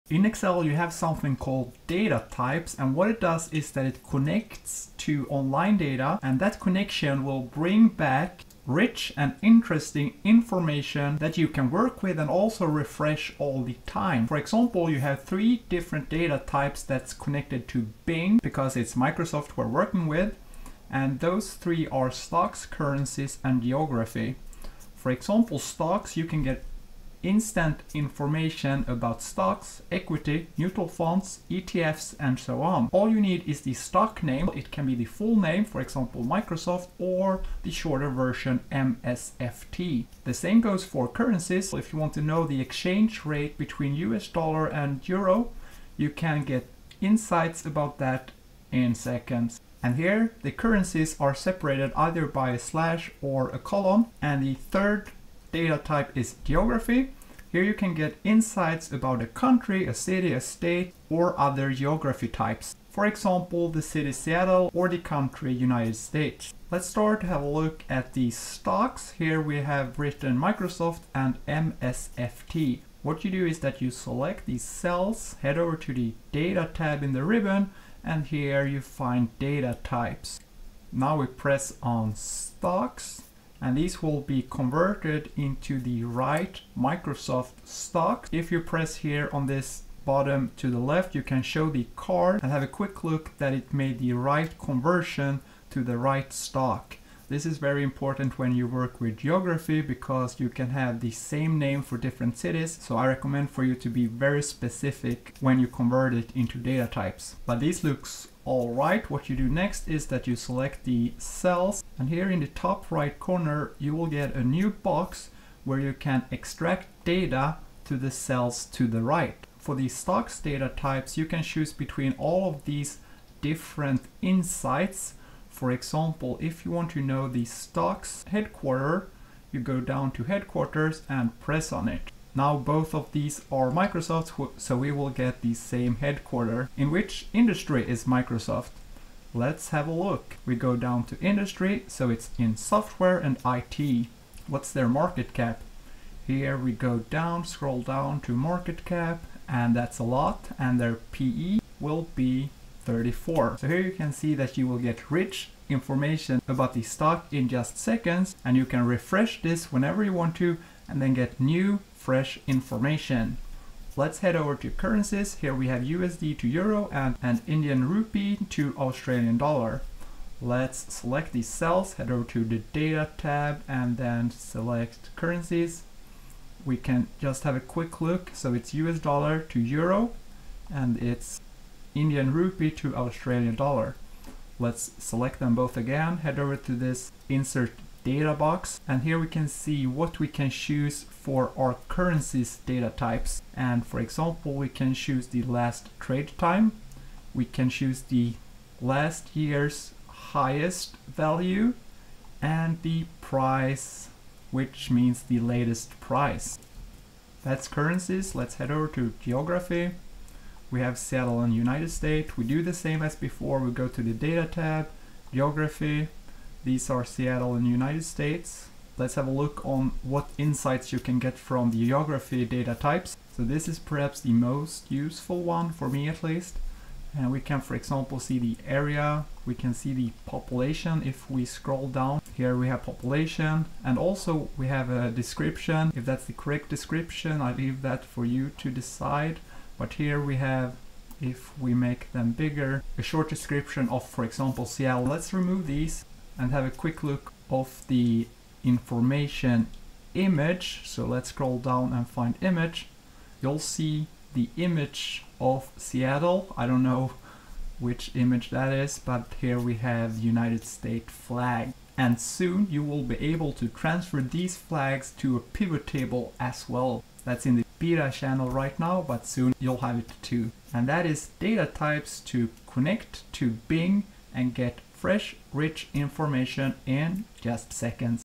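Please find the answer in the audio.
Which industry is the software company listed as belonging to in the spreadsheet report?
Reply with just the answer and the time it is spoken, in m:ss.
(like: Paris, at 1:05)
software and IT, at 2:22.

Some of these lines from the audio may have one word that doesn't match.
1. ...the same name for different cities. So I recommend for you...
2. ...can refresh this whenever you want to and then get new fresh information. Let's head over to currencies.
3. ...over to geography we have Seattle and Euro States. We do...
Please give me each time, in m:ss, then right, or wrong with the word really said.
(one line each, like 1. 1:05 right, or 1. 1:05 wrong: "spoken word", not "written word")
1. 1:40 right
2. 2:38 right
3. 3:28 wrong: "United", not "Euro".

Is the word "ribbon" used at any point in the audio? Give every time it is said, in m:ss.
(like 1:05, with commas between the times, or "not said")
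1:17.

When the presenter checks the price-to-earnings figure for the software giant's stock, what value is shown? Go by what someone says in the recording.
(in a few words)
34.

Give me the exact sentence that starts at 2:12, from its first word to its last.
Now both of these are Microsoft's, so we will get the same headquarter.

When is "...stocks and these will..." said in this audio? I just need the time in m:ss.
1:22.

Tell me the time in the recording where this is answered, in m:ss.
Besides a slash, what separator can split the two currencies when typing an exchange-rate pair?
0:53.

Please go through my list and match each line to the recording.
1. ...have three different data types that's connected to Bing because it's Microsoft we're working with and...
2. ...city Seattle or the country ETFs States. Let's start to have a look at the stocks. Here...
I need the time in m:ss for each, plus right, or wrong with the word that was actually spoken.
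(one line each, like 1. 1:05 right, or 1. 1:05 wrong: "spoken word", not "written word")
1. 0:14 right
2. 1:03 wrong: "United", not "ETFs".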